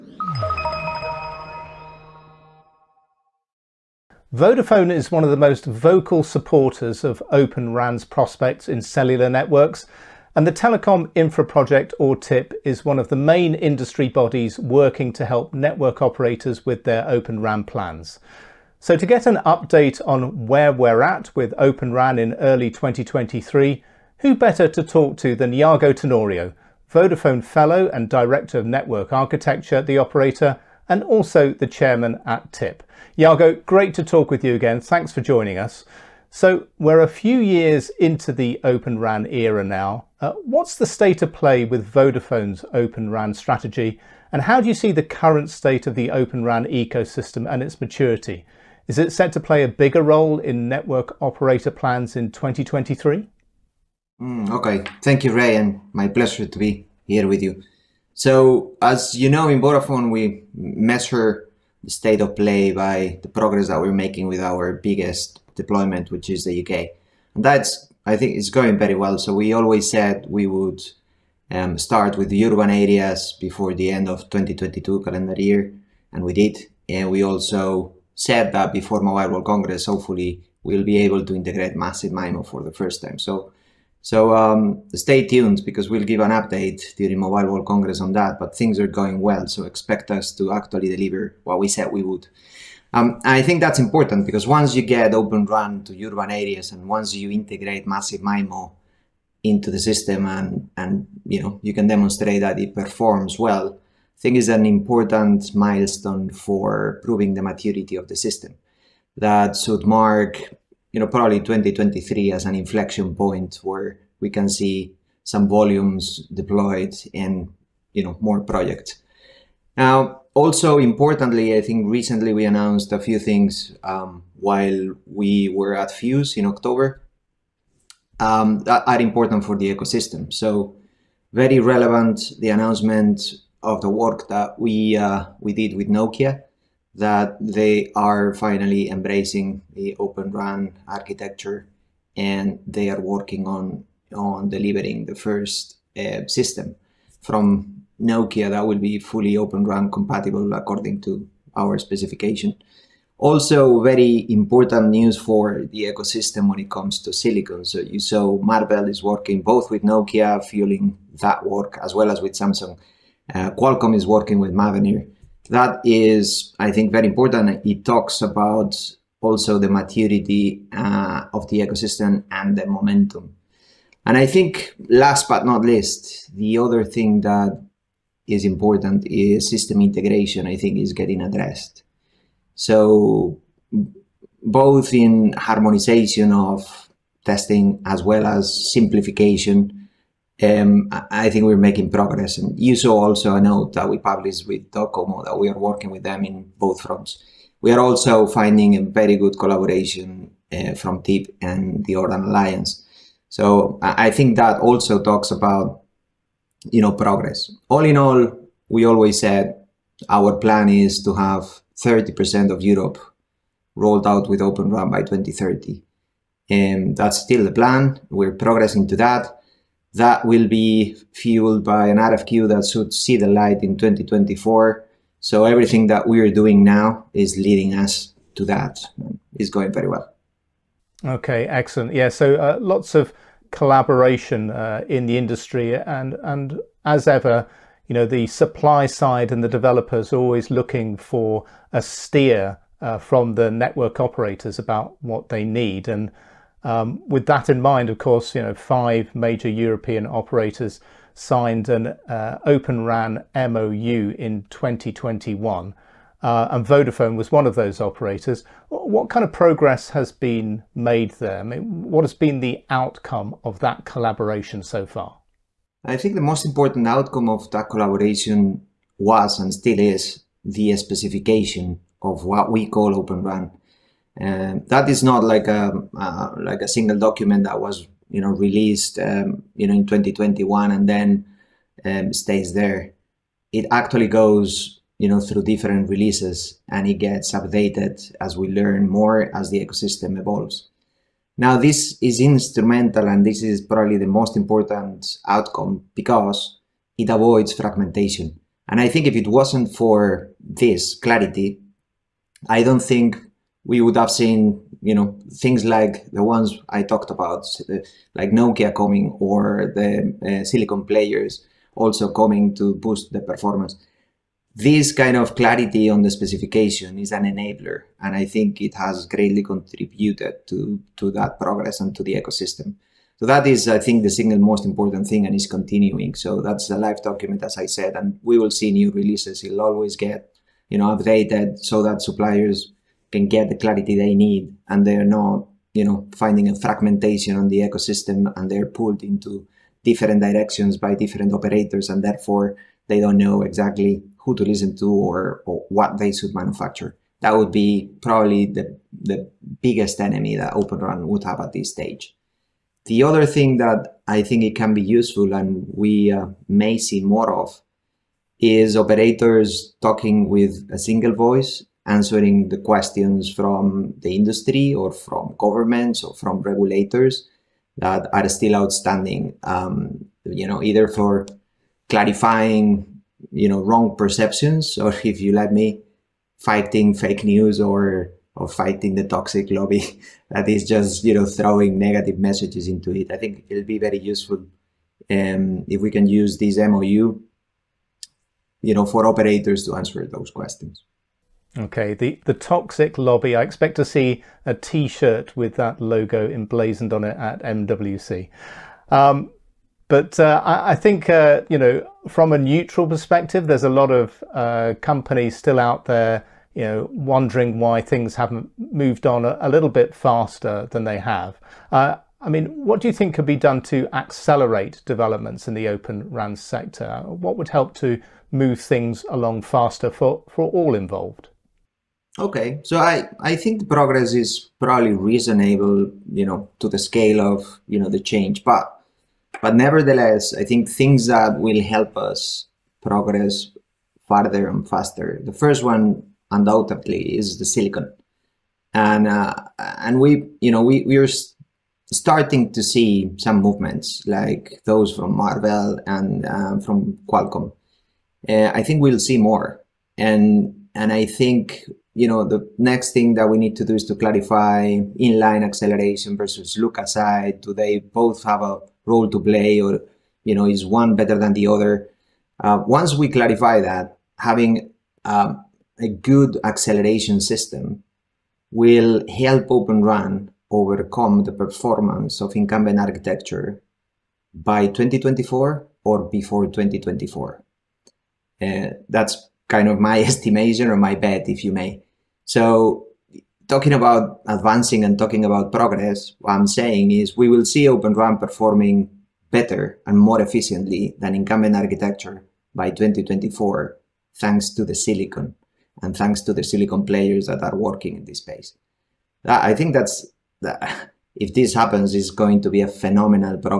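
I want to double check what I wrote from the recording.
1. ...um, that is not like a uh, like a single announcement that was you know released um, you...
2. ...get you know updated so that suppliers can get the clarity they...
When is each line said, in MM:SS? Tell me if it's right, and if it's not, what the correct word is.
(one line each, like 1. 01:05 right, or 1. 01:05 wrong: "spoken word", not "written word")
1. 04:34 wrong: "document", not "announcement"
2. 05:29 right.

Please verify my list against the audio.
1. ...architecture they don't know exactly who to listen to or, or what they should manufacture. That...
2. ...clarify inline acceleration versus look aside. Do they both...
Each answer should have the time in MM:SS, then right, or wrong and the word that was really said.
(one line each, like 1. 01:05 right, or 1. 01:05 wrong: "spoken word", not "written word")
1. 05:42 wrong: "therefore", not "architecture"
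2. 07:33 right.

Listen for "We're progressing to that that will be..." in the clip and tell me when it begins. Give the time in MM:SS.
03:38.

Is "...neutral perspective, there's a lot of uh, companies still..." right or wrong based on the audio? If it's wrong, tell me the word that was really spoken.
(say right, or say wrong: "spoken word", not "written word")
right.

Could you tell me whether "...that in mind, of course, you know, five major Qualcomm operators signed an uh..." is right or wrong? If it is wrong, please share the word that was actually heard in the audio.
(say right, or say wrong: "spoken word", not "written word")
wrong: "European", not "Qualcomm".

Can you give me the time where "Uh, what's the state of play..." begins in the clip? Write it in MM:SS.
00:40.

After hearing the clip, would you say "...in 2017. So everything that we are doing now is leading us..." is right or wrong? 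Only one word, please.
wrong.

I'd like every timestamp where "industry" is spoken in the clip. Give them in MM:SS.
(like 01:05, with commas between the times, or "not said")
00:13, 03:55, 06:04.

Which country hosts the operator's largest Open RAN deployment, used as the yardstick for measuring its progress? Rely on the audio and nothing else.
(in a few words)
UK.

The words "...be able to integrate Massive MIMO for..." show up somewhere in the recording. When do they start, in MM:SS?
01:20.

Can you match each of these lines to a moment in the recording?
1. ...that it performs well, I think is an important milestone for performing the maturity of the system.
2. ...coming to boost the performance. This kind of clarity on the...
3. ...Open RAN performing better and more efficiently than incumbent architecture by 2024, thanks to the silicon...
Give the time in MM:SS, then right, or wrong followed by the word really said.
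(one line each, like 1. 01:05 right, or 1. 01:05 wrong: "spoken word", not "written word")
1. 01:42 wrong: "proving", not "performing"
2. 05:12 right
3. 08:07 right.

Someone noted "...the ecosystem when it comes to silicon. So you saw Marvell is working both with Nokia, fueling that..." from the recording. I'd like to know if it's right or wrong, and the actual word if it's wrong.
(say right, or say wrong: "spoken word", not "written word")
right.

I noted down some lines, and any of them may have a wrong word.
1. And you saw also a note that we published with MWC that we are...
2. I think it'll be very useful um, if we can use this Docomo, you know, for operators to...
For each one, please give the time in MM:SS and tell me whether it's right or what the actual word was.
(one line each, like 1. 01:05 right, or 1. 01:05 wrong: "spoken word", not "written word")
1. 03:12 wrong: "Docomo", not "MWC"
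2. 06:23 wrong: "MOU", not "Docomo".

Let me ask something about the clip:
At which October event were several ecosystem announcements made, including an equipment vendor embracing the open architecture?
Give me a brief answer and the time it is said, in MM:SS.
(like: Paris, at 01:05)
FYUZ, at 02:05.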